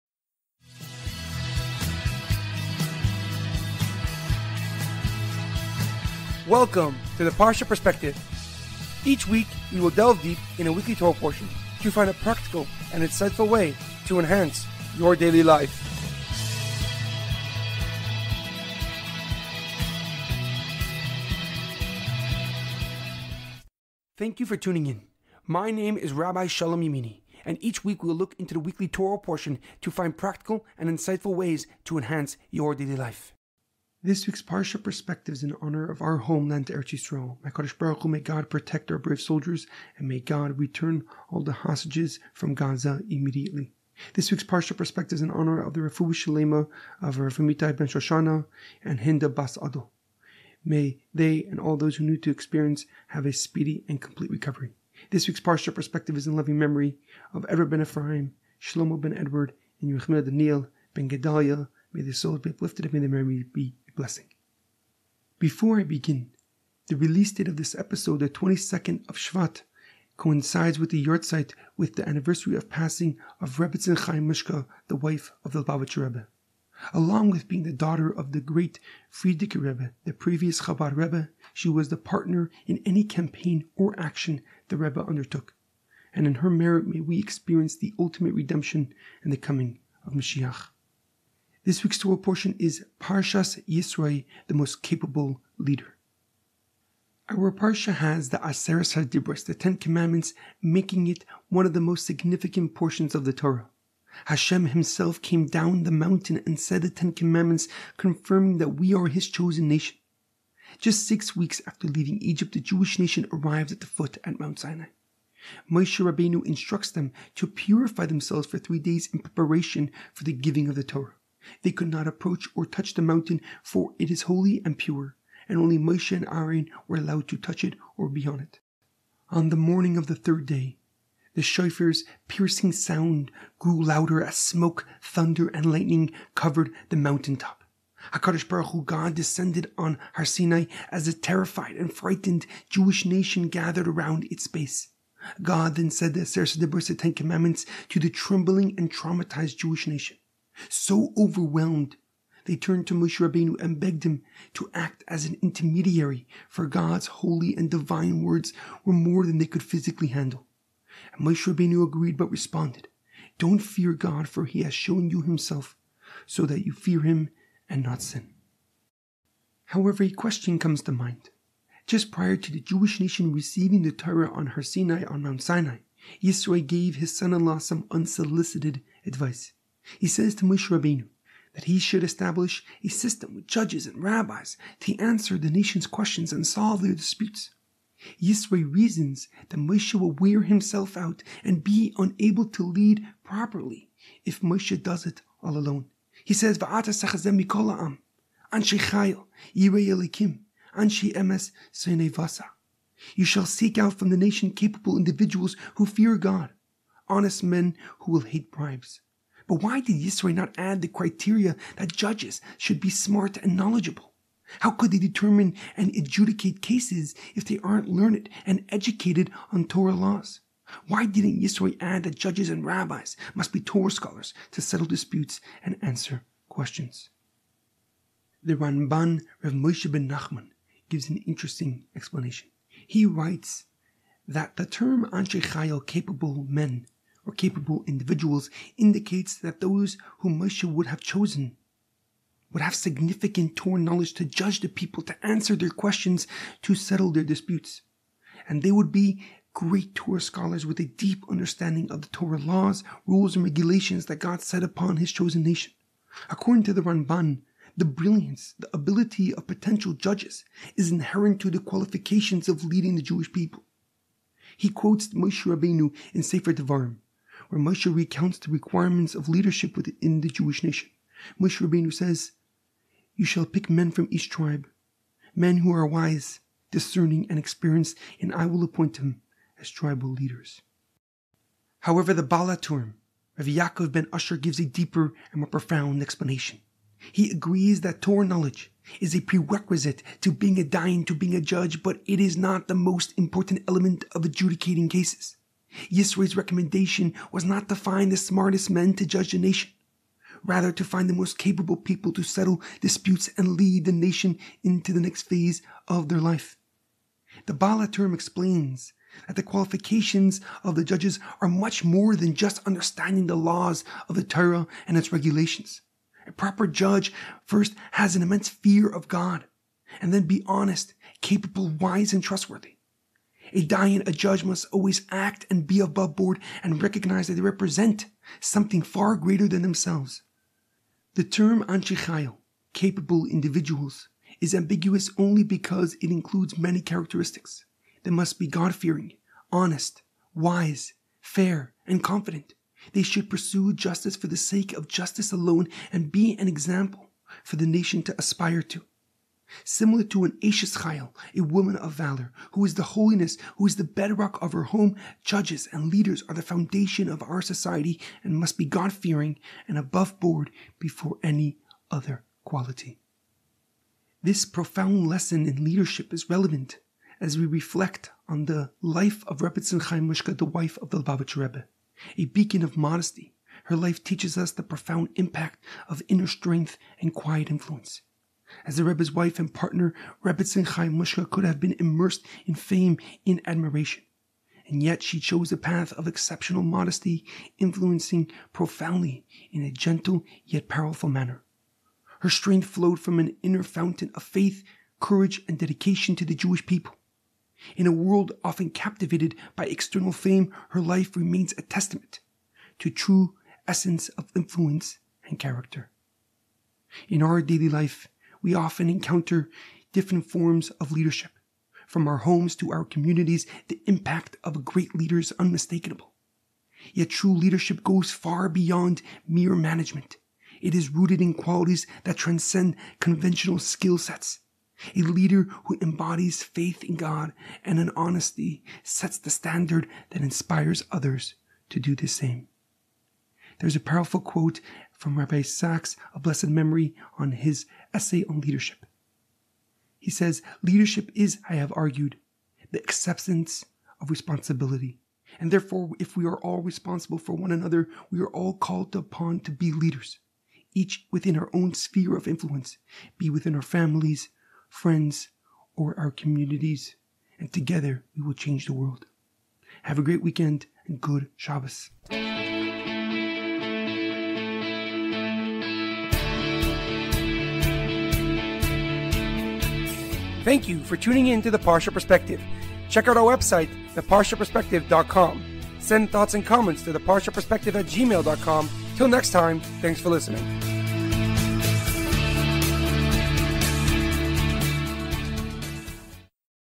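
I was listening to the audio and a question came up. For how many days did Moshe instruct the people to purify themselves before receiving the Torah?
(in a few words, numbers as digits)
3.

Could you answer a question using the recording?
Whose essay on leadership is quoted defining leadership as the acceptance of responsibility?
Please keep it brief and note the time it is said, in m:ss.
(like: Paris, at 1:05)
Rabbi Sacks, at 7:15.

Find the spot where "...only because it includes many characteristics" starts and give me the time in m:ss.
5:35.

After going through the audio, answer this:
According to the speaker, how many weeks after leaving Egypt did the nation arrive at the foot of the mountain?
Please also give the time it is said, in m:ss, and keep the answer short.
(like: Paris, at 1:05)
6, at 1:51.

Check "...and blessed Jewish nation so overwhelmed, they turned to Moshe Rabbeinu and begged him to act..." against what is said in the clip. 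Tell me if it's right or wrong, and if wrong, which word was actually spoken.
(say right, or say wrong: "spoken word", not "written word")
wrong: "traumatized", not "blessed".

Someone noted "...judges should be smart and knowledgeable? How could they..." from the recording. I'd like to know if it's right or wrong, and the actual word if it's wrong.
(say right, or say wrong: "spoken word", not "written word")
right.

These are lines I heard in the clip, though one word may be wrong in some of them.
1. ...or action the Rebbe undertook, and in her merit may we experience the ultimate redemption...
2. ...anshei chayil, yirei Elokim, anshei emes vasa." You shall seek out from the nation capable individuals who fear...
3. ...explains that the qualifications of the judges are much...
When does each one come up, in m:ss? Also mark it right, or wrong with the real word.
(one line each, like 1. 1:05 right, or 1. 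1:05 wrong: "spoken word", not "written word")
1. 1:23 right
2. 3:18 right
3. 5:08 right.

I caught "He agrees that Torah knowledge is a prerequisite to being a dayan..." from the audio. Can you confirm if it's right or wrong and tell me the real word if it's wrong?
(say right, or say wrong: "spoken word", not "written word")
right.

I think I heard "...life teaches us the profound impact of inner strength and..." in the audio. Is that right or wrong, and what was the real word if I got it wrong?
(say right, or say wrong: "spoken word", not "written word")
right.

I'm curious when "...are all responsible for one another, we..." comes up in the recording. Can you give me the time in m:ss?
7:26.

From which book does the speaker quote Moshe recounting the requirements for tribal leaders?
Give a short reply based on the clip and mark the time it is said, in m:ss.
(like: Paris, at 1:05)
Sefer Devarim, at 4:26.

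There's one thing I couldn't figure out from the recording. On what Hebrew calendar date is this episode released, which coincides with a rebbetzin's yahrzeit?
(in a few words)
22nd of Shvat.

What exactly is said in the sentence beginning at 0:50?
May they and all those who knew to experience have a speedy and complete recovery.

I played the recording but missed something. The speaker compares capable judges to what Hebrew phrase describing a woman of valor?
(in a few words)
Eishes Chayil.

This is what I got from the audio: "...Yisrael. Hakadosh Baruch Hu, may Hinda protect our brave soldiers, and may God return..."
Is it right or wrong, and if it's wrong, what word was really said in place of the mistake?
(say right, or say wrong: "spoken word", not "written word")
wrong: "God", not "Hinda".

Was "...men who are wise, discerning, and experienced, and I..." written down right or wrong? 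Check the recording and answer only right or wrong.
right.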